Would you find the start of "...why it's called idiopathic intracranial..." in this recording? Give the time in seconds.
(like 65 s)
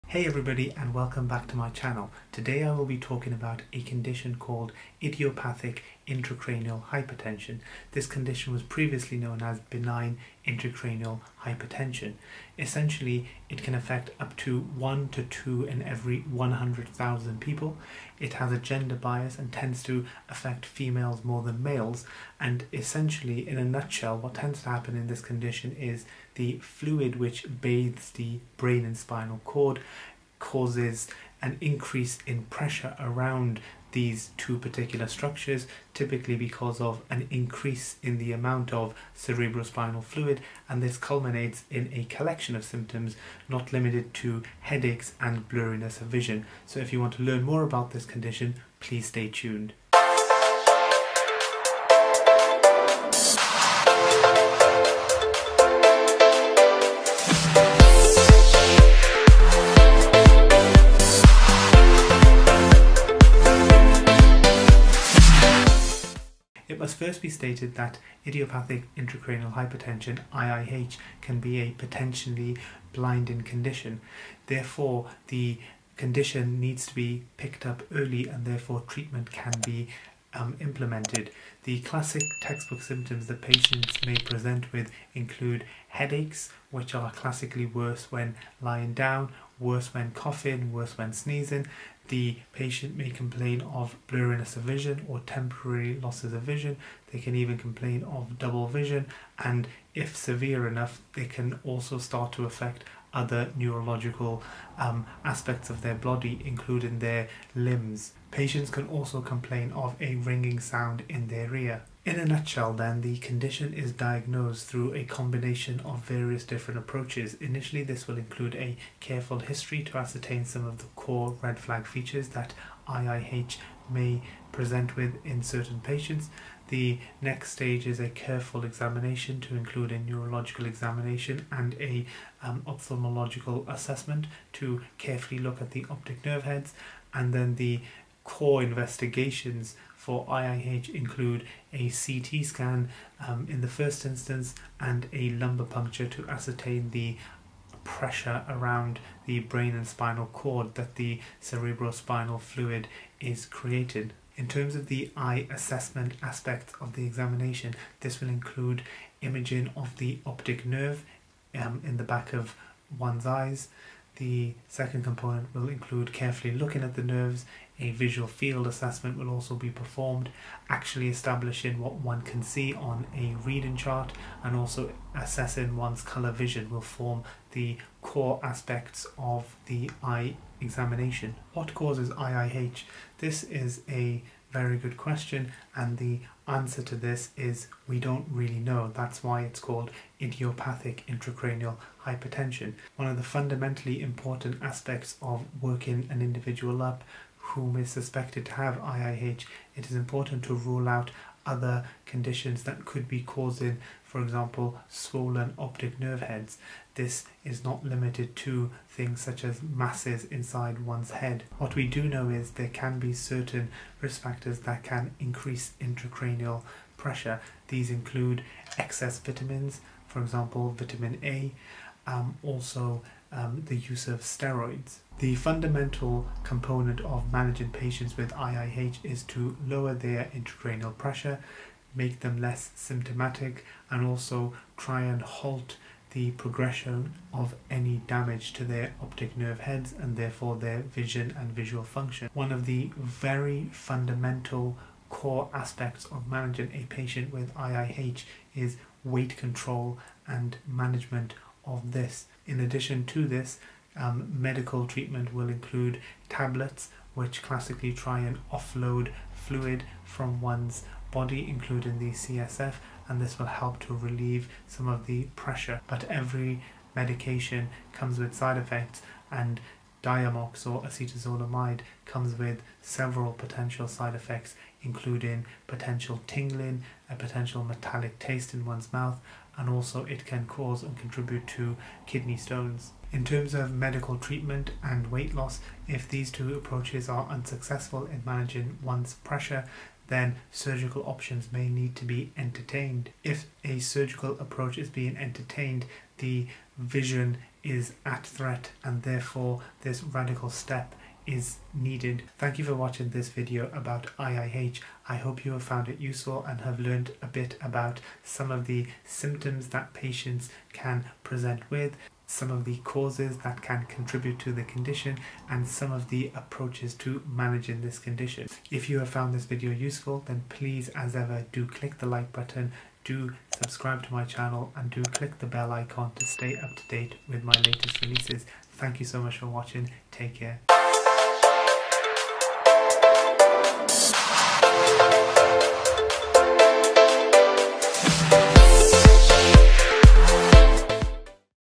189 s.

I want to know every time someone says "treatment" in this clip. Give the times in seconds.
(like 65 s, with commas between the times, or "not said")
78 s, 254 s, 284 s.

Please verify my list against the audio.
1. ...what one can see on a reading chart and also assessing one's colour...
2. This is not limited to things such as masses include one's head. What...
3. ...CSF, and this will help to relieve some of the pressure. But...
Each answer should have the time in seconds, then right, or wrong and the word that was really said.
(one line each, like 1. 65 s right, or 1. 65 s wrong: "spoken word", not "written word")
1. 171 s right
2. 206 s wrong: "inside", not "include"
3. 262 s right.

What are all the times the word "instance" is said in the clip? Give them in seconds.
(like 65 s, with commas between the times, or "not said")
144 s.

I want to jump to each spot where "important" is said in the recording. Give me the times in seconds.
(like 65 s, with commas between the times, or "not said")
194 s, 199 s.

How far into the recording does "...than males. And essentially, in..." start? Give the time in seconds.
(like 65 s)
21 s.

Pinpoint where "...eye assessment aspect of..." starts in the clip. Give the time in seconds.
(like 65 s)
155 s.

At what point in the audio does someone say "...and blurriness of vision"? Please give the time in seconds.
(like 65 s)
45 s.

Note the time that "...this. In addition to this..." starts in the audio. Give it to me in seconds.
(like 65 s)
251 s.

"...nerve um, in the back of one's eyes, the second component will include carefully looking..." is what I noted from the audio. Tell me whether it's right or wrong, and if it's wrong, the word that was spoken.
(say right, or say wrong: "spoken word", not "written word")
right.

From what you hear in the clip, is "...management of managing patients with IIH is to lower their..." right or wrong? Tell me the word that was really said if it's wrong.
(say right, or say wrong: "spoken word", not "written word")
wrong: "component", not "management".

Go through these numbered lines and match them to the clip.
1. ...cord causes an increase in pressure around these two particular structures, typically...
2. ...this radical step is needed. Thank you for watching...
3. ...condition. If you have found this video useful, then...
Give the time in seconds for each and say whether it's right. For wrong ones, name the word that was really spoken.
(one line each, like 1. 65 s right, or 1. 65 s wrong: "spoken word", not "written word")
1. 29 s right
2. 299 s right
3. 317 s right.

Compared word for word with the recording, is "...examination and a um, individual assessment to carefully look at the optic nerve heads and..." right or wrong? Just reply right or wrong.
wrong.